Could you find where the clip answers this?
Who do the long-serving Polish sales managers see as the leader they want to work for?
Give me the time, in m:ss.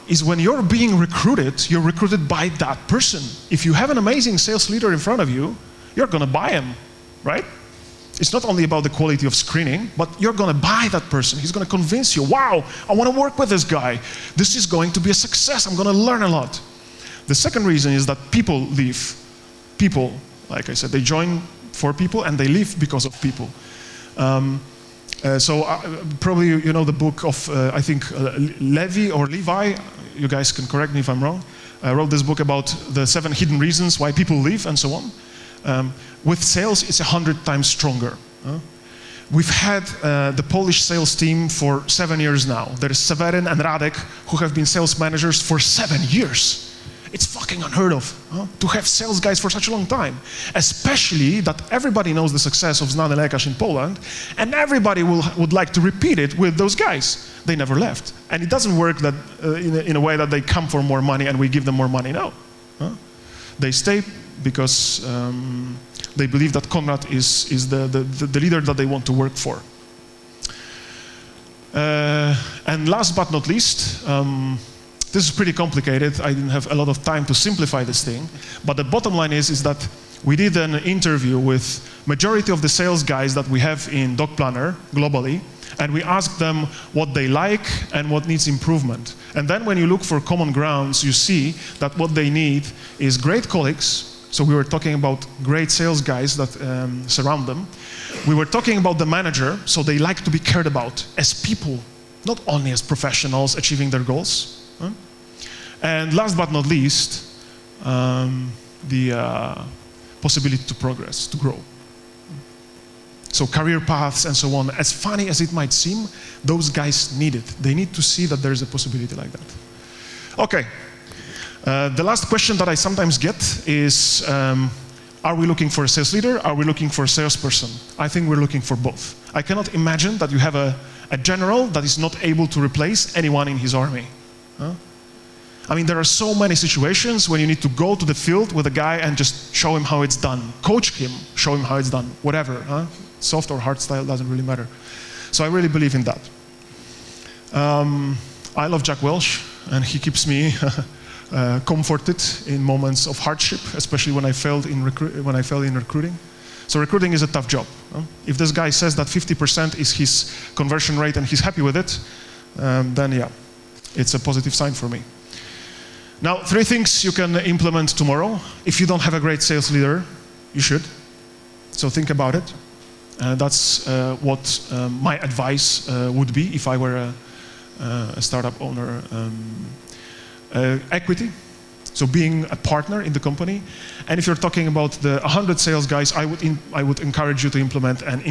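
1:06.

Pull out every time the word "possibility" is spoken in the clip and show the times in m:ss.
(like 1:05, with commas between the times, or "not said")
1:50, 1:58.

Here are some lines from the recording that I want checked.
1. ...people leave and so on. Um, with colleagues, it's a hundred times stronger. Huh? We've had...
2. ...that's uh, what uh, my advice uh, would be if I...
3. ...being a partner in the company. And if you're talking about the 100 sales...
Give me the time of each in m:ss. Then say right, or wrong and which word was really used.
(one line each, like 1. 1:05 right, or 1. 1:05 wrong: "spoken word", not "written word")
1. 0:34 wrong: "sales", not "colleagues"
2. 2:53 right
3. 3:02 right.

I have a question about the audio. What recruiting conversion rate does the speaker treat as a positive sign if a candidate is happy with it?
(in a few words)
50%.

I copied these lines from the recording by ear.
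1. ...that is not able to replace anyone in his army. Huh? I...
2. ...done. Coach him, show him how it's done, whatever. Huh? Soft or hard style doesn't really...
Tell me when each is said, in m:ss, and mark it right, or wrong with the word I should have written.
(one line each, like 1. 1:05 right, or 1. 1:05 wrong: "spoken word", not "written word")
1. 2:11 right
2. 2:20 right.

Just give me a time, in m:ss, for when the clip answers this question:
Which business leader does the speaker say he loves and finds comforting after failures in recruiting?
2:28.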